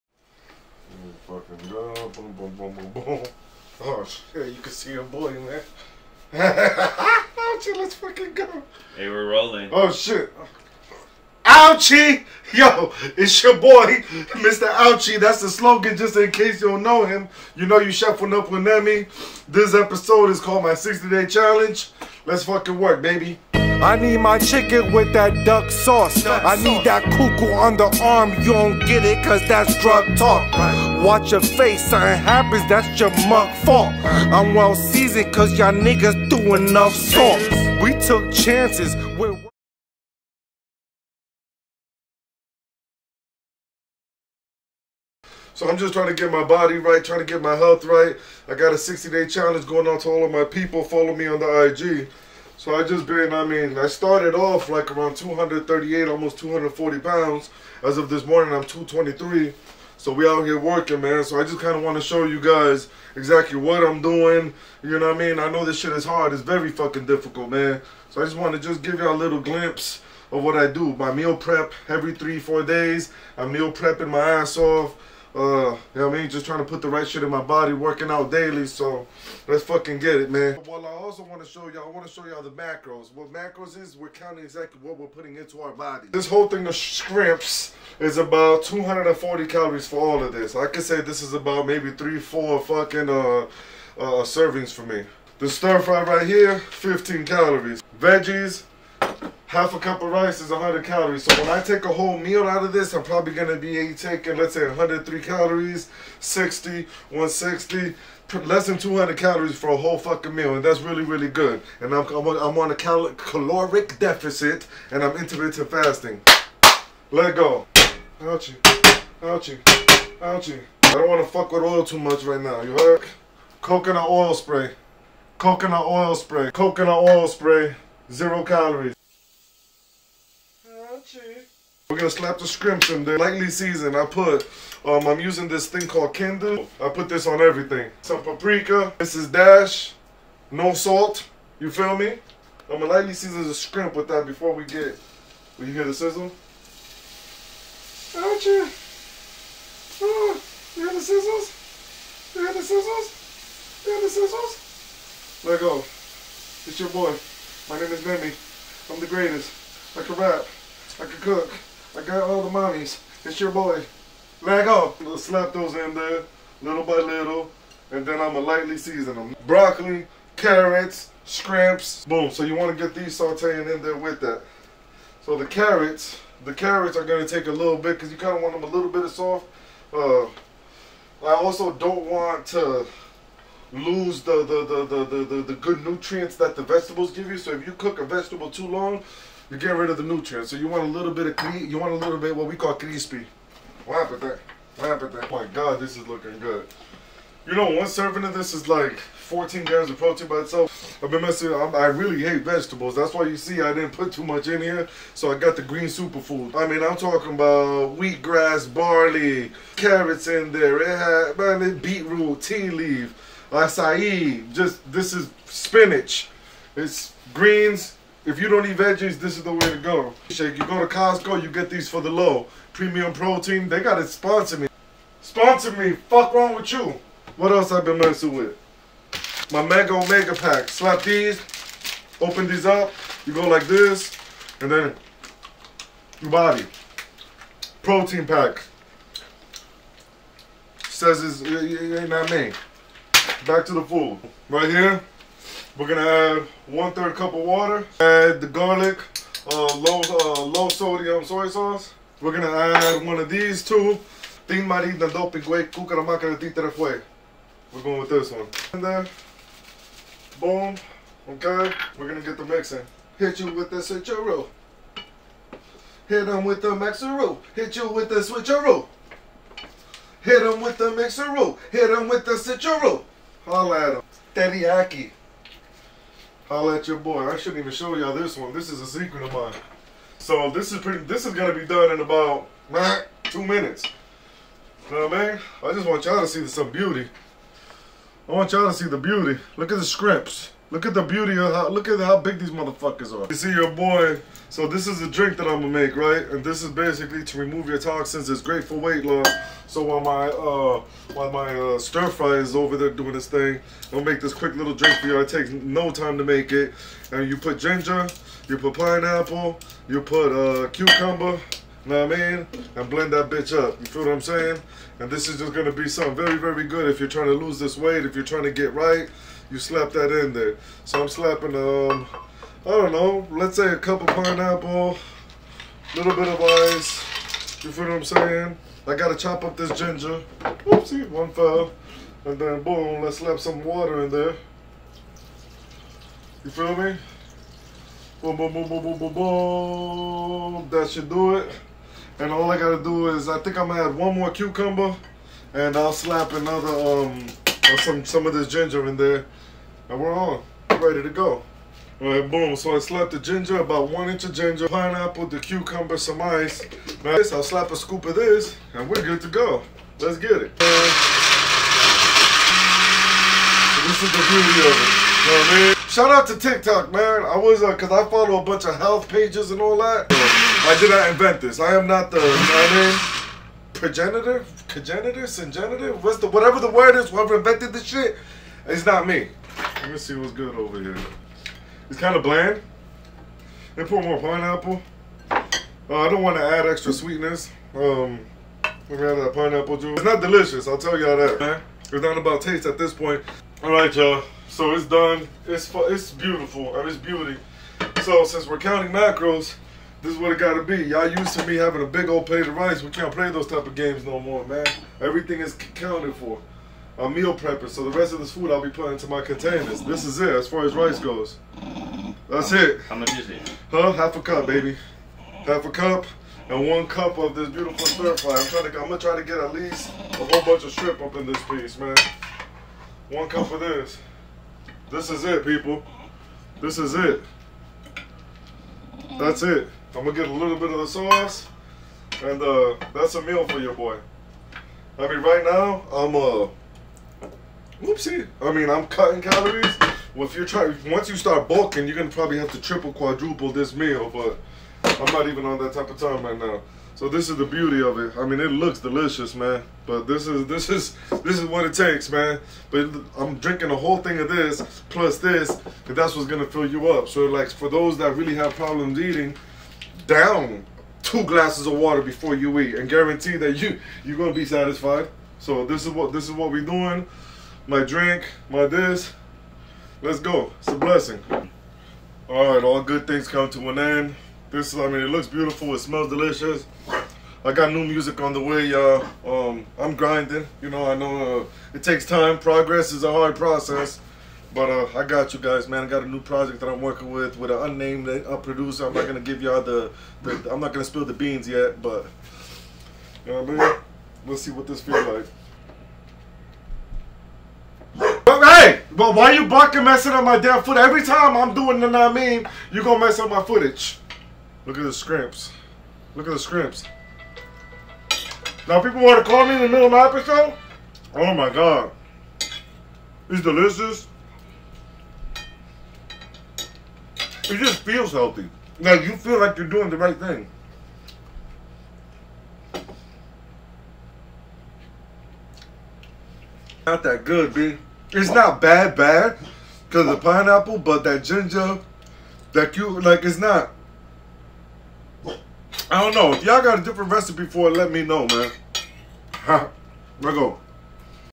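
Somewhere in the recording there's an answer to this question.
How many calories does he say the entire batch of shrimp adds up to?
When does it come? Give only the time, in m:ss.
1:28.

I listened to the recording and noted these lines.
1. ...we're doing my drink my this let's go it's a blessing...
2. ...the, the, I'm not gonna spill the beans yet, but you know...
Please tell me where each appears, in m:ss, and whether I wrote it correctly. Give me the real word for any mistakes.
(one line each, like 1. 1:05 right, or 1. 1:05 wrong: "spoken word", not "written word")
1. 7:46 right
2. 8:09 right.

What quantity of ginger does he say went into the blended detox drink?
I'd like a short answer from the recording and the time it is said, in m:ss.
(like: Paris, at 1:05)
One inch, at 5:53.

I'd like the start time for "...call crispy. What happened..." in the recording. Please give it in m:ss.
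3:12.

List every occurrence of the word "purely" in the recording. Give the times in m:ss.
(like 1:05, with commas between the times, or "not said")
not said.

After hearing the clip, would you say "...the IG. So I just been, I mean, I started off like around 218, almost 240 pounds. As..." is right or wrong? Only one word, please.
wrong.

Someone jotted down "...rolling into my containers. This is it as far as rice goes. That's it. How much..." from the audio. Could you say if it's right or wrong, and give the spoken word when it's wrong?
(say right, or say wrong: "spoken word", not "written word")
wrong: "putting", not "rolling".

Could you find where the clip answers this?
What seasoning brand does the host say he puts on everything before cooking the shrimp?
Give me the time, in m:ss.
2:16.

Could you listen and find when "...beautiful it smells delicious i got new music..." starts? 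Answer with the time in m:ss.
7:55.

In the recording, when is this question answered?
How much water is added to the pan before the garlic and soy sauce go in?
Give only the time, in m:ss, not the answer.
4:06.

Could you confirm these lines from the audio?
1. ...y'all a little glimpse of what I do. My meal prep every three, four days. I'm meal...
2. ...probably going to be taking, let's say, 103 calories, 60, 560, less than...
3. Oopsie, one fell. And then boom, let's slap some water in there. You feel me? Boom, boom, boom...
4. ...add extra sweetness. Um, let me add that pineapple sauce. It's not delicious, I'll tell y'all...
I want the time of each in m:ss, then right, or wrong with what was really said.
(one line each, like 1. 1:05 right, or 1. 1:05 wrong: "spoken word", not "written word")
1. 1:08 right
2. 1:43 wrong: "160", not "560"
3. 5:30 right
4. 6:26 wrong: "juice", not "sauce".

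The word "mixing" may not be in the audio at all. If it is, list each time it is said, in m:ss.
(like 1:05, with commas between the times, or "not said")
4:22.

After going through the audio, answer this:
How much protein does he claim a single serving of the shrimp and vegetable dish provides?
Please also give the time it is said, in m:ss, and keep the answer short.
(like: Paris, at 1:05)
14 grams, at 3:18.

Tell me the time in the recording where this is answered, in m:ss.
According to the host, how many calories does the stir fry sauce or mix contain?
1:36.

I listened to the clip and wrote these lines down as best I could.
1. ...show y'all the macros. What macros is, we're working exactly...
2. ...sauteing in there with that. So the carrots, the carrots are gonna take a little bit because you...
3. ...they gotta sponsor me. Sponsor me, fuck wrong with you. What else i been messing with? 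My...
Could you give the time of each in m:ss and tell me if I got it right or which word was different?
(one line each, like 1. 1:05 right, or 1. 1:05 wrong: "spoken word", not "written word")
1. 1:22 wrong: "counting", not "working"
2. 2:53 right
3. 3:43 right.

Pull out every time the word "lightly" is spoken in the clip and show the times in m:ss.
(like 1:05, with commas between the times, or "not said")
2:13, 2:22, 2:48.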